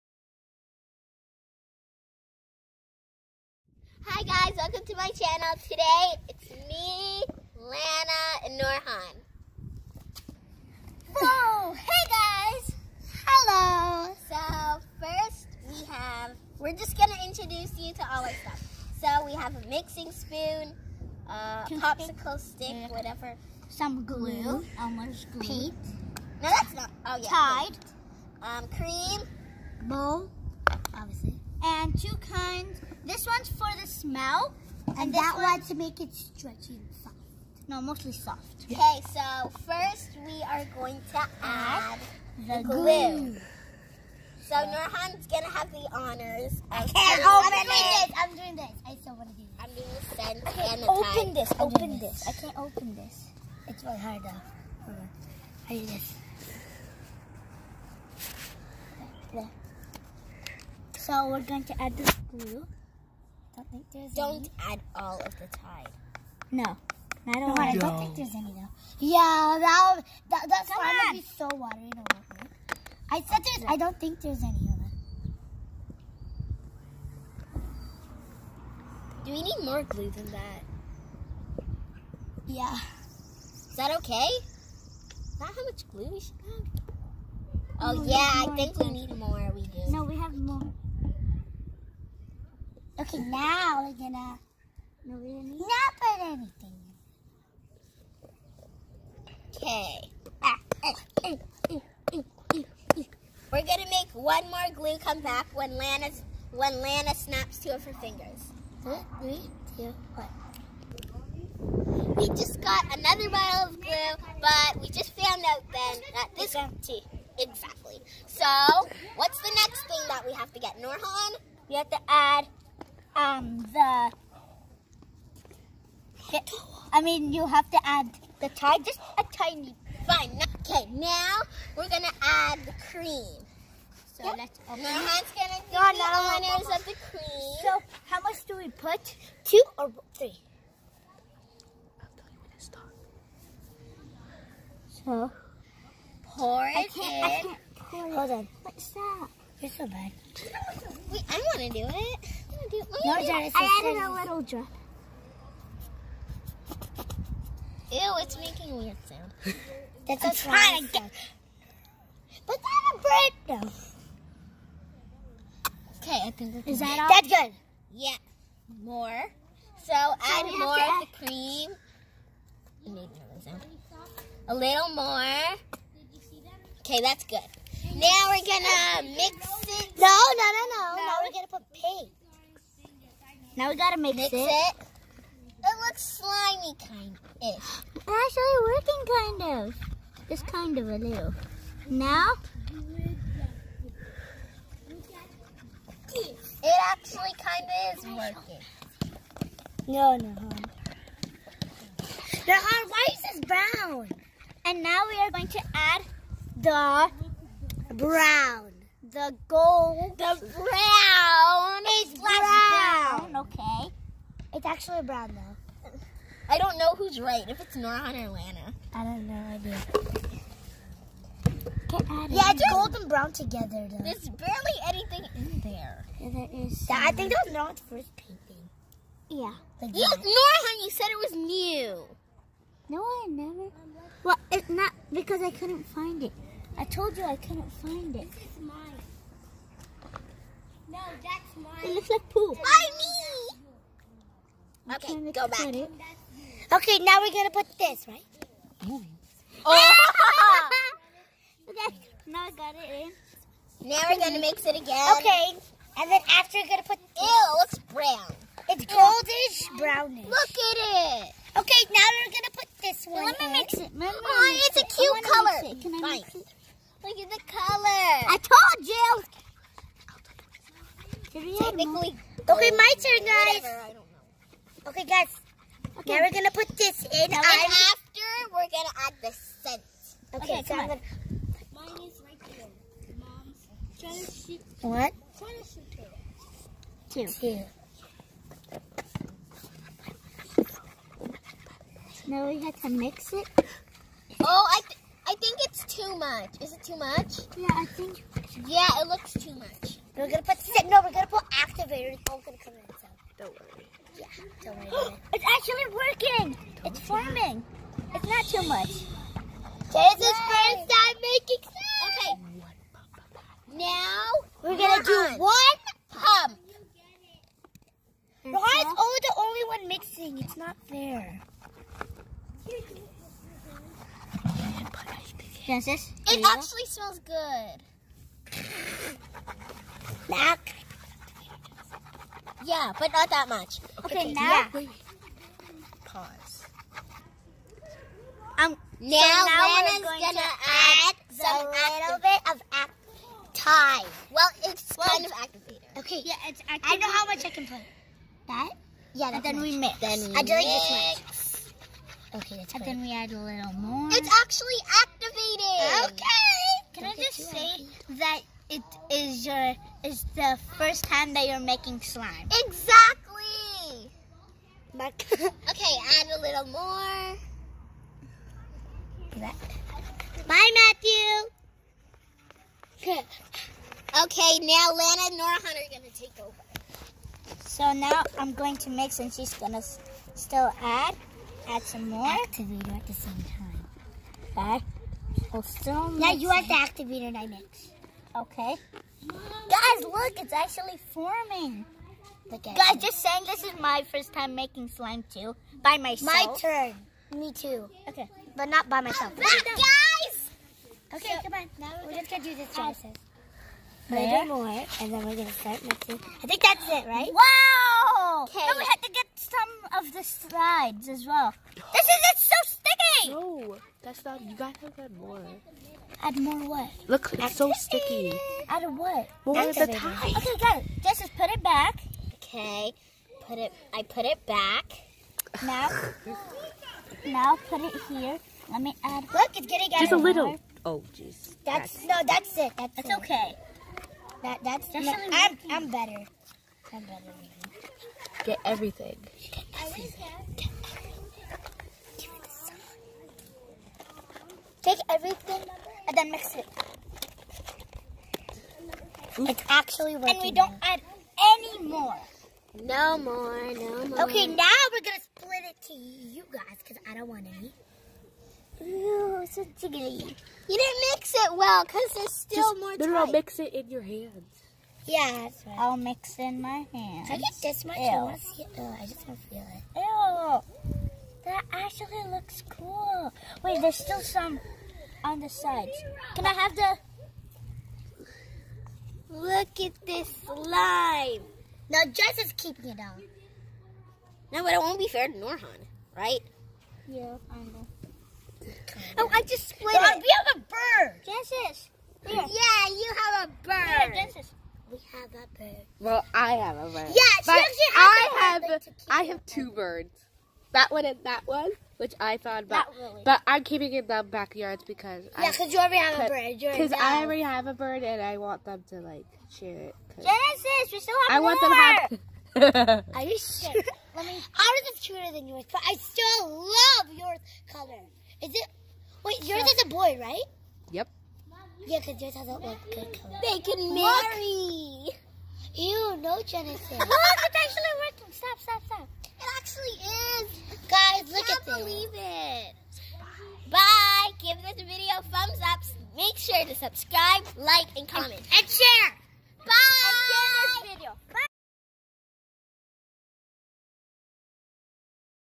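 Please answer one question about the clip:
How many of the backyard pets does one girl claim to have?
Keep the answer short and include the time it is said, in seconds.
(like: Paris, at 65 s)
2, at 499 s.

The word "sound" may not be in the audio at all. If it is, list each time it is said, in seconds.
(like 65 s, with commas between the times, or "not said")
159 s, 173 s.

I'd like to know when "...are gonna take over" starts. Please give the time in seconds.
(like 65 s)
375 s.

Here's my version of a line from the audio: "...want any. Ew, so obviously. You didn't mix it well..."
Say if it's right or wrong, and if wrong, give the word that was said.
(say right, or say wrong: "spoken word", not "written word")
wrong: "jiggly", not "obviously".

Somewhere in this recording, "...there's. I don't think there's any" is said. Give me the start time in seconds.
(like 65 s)
73 s.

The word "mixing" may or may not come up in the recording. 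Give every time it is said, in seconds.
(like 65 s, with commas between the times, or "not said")
19 s, 319 s, 405 s.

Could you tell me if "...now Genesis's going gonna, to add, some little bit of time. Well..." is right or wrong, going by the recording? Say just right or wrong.
wrong.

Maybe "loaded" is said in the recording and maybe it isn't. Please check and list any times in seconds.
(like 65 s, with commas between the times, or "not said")
not said.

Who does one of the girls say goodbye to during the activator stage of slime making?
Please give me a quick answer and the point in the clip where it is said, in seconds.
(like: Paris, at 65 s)
Matthew, at 370 s.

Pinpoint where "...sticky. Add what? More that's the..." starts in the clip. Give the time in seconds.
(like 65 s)
417 s.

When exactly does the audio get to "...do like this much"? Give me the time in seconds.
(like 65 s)
350 s.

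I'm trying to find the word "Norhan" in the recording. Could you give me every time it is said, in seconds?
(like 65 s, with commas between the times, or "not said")
8 s, 44 s, 120 s, 227 s, 485 s.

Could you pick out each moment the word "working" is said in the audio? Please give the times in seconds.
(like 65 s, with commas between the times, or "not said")
188 s, 198 s, 305 s, 450 s, 528 s.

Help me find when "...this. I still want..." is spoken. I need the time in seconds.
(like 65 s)
48 s.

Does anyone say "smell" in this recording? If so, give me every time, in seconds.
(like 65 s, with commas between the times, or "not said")
33 s, 326 s.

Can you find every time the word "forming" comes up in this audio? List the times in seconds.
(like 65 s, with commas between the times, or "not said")
306 s, 391 s.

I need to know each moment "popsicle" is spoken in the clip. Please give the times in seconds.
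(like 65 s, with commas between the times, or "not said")
21 s.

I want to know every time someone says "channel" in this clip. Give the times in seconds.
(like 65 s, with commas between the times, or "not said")
5 s.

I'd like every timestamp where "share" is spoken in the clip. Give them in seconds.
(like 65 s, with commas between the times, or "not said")
509 s, 538 s.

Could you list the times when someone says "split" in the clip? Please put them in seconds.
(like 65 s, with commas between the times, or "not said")
455 s, 489 s.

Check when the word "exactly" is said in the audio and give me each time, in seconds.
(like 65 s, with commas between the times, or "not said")
117 s, 362 s.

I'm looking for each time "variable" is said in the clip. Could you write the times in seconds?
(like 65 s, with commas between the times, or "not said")
not said.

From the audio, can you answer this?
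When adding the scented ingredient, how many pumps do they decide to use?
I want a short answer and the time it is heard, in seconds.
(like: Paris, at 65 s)
1, at 315 s.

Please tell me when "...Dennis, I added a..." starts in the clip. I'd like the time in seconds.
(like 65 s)
153 s.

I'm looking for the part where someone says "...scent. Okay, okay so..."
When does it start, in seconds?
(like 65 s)
279 s.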